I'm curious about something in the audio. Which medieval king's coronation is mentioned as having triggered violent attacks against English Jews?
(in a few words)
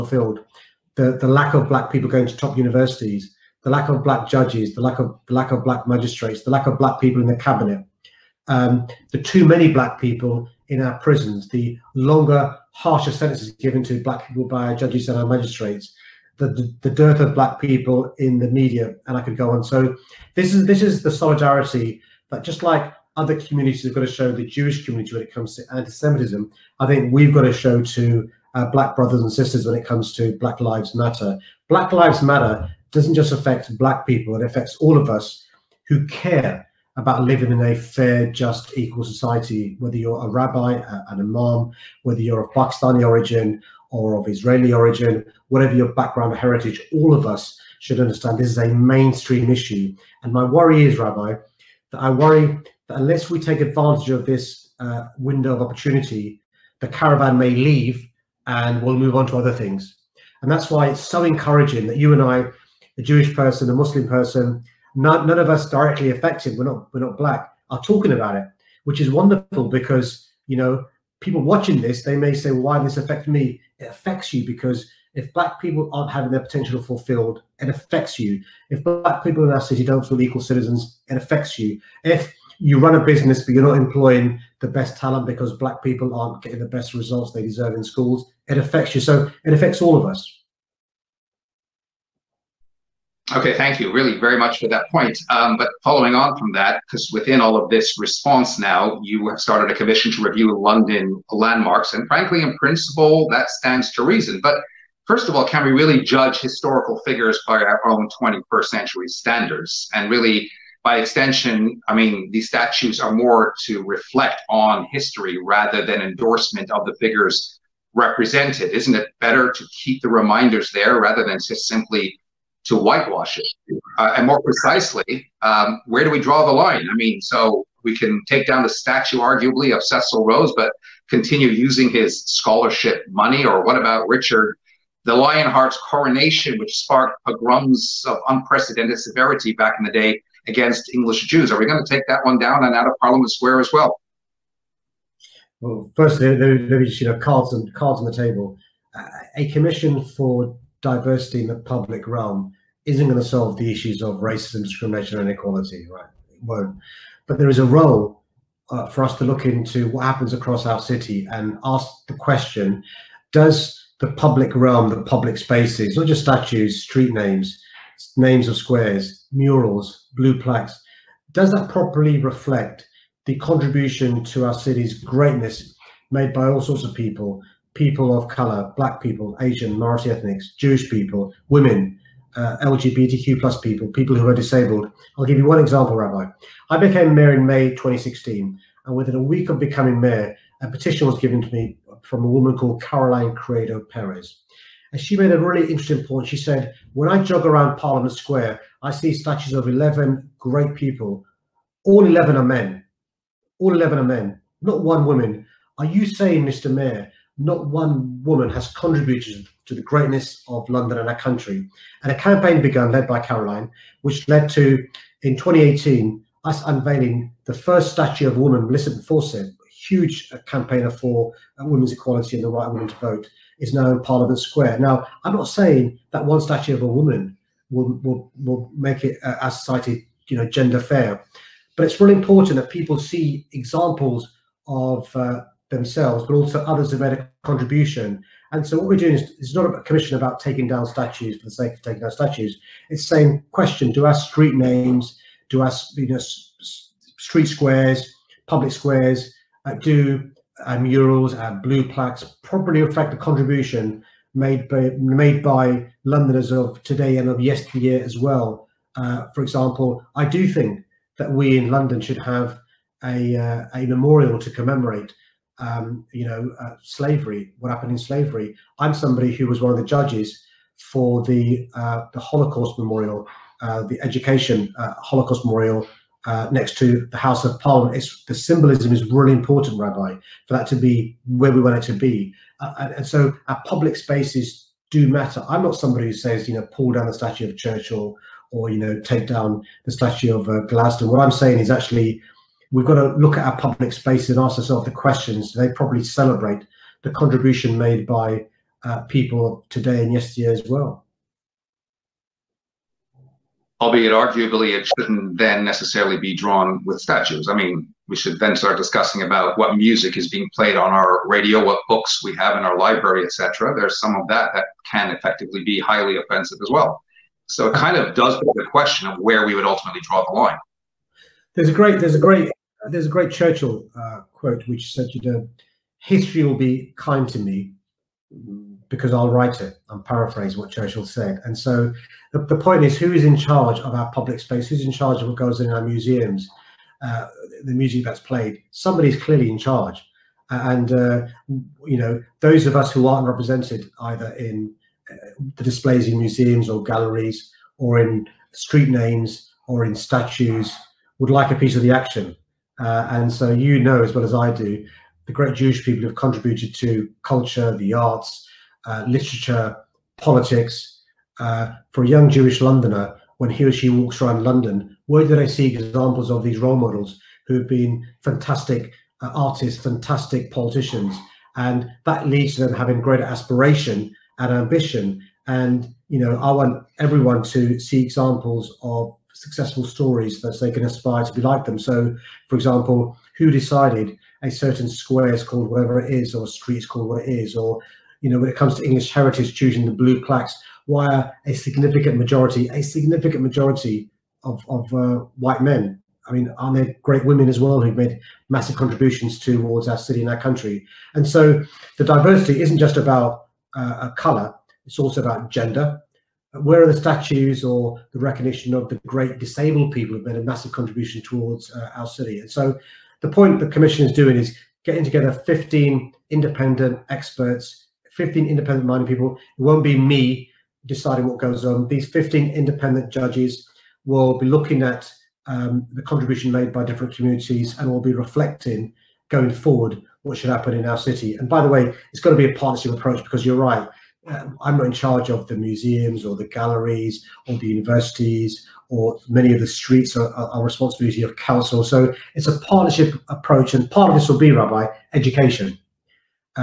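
Richard the Lionheart.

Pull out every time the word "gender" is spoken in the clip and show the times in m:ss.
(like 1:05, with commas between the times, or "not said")
3:50, 6:45.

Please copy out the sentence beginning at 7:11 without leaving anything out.
And by the way, it's got to be a partnership approach because you're right.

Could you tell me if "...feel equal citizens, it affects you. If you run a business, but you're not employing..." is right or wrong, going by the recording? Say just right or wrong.
right.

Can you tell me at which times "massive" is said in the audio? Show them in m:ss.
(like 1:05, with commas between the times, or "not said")
6:38, 6:50.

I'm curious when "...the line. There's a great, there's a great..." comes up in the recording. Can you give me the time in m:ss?
5:20.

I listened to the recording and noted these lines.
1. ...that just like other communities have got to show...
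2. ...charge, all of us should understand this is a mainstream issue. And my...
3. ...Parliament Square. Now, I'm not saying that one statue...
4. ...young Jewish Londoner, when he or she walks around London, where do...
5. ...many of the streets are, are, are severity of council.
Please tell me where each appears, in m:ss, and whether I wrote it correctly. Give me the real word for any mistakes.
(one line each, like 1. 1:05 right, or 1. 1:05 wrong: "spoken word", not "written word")
1. 0:22 right
2. 0:46 wrong: "heritage", not "charge"
3. 3:44 right
4. 6:02 right
5. 7:19 wrong: "responsibility", not "severity".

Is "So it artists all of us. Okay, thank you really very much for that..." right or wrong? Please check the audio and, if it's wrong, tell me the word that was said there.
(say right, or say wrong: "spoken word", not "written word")
wrong: "affects", not "artists".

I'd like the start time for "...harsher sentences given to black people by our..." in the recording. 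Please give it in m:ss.
0:12.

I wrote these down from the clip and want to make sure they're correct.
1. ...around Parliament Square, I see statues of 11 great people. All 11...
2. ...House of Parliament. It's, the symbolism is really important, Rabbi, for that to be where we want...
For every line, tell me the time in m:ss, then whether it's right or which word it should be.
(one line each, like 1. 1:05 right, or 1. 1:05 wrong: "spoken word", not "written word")
1. 3:17 right
2. 4:37 right.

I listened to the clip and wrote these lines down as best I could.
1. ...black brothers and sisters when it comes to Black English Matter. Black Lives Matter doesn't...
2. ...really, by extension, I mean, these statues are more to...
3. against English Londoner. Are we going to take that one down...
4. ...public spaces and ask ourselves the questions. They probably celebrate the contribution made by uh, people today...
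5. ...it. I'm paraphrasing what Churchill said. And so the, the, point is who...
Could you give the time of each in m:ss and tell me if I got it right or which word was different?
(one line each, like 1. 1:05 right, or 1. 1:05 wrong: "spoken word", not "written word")
1. 0:28 wrong: "Lives", not "English"
2. 1:50 right
3. 2:20 wrong: "Jews", not "Londoner"
4. 4:53 right
5. 5:29 right.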